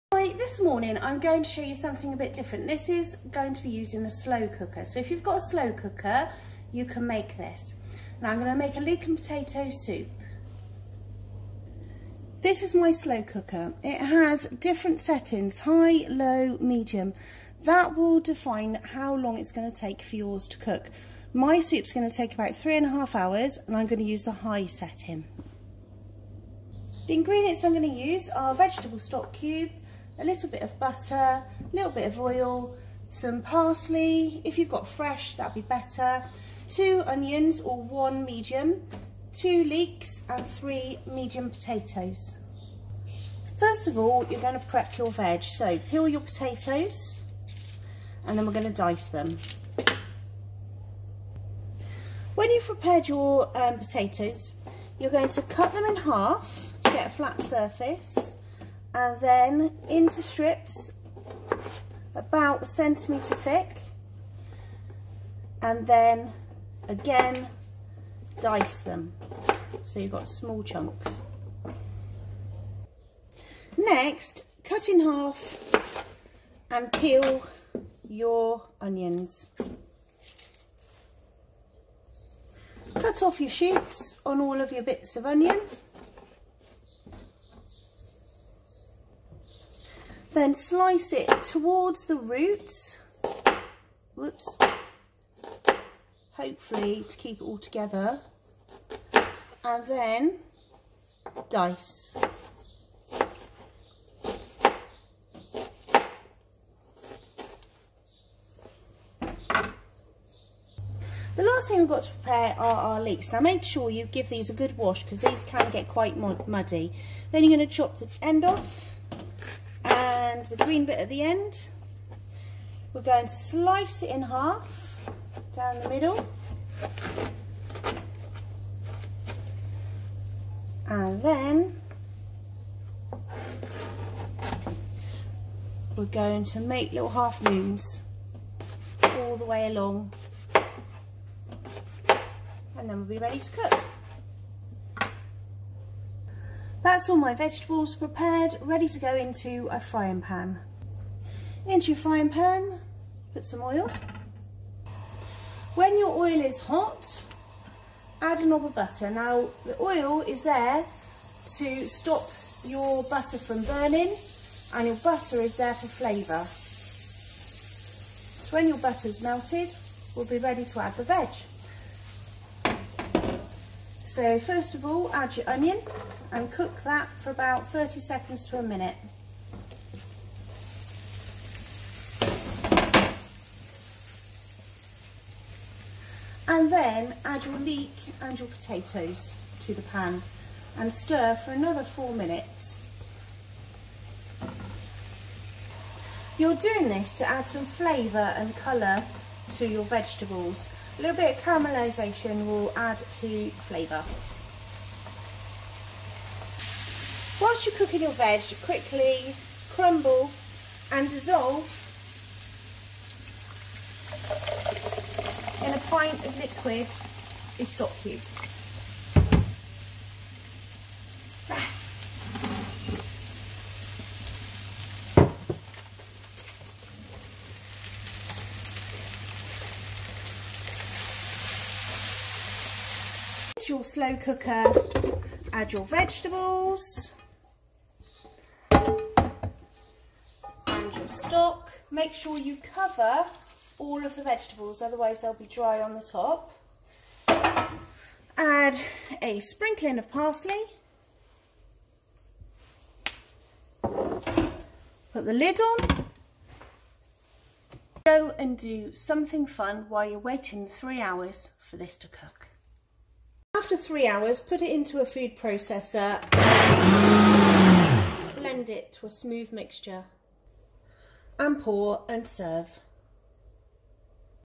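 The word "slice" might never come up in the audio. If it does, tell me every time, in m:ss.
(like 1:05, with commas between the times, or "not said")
1:30, 2:03.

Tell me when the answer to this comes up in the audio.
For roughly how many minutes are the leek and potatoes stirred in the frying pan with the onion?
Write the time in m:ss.
3:11.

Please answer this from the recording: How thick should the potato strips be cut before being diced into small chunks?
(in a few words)
1 centimetre.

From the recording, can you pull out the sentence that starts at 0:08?
Now I'm going to make a leek and potato soup.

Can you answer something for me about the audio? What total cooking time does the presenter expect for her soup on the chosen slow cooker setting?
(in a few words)
3 and a half hours.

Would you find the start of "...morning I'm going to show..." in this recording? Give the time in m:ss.
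0:00.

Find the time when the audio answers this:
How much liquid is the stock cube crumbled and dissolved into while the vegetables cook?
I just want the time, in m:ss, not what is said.
3:35.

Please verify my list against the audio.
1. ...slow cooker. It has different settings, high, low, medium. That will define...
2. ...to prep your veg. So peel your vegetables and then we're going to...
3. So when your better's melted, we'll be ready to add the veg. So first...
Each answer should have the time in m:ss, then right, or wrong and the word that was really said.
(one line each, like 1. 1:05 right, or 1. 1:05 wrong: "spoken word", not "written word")
1. 0:12 right
2. 0:44 wrong: "potatoes", not "vegetables"
3. 2:48 wrong: "butter", not "better".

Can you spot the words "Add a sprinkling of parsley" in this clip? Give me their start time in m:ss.
4:08.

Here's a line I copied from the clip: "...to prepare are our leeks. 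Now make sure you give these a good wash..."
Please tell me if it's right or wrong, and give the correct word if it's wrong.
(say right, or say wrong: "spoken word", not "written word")
right.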